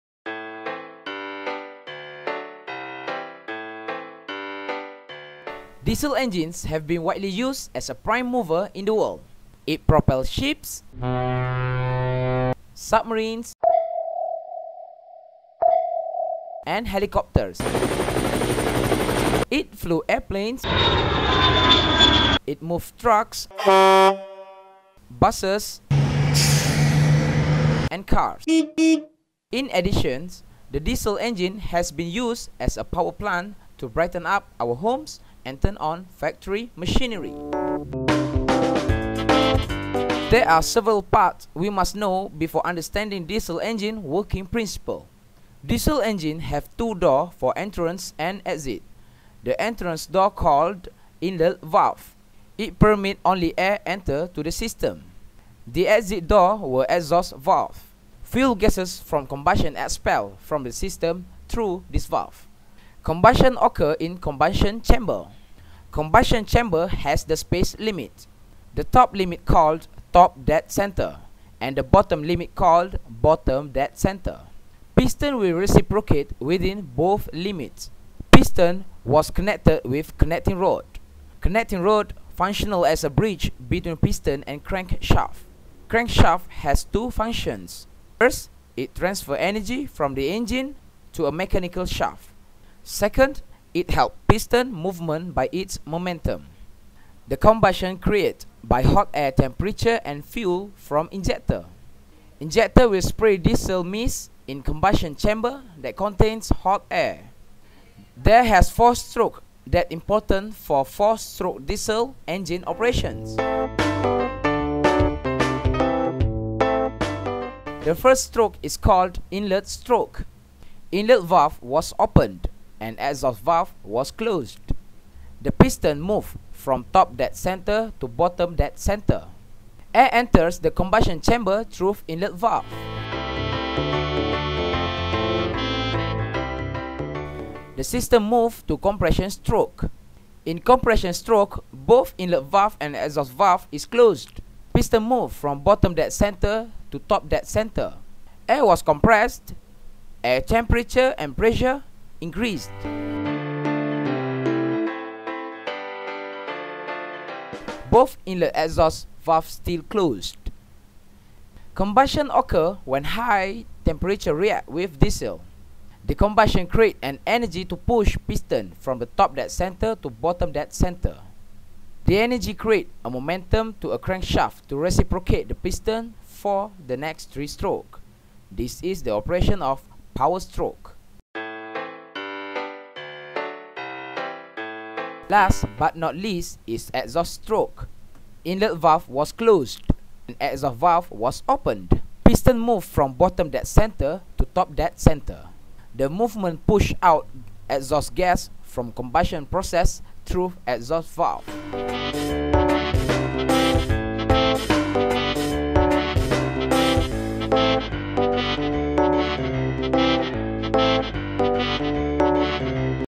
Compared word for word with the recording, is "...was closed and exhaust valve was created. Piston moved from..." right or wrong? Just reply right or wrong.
wrong.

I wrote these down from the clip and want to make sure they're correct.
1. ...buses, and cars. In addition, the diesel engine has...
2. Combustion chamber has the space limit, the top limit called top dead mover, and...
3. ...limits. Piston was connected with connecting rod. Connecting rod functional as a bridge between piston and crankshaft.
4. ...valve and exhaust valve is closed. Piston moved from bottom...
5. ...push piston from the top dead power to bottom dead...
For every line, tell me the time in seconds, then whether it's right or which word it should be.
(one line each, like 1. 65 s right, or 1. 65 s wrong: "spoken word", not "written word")
1. 25 s right
2. 65 s wrong: "center", not "mover"
3. 77 s right
4. 142 s right
5. 167 s wrong: "center", not "power".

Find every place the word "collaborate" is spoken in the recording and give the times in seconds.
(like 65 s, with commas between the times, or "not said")
not said.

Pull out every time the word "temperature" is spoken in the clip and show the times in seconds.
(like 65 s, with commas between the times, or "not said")
99 s, 150 s, 163 s.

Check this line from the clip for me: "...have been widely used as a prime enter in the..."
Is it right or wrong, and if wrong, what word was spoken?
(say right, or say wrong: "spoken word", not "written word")
wrong: "mover", not "enter".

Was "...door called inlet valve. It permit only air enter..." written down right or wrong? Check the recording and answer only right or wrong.
right.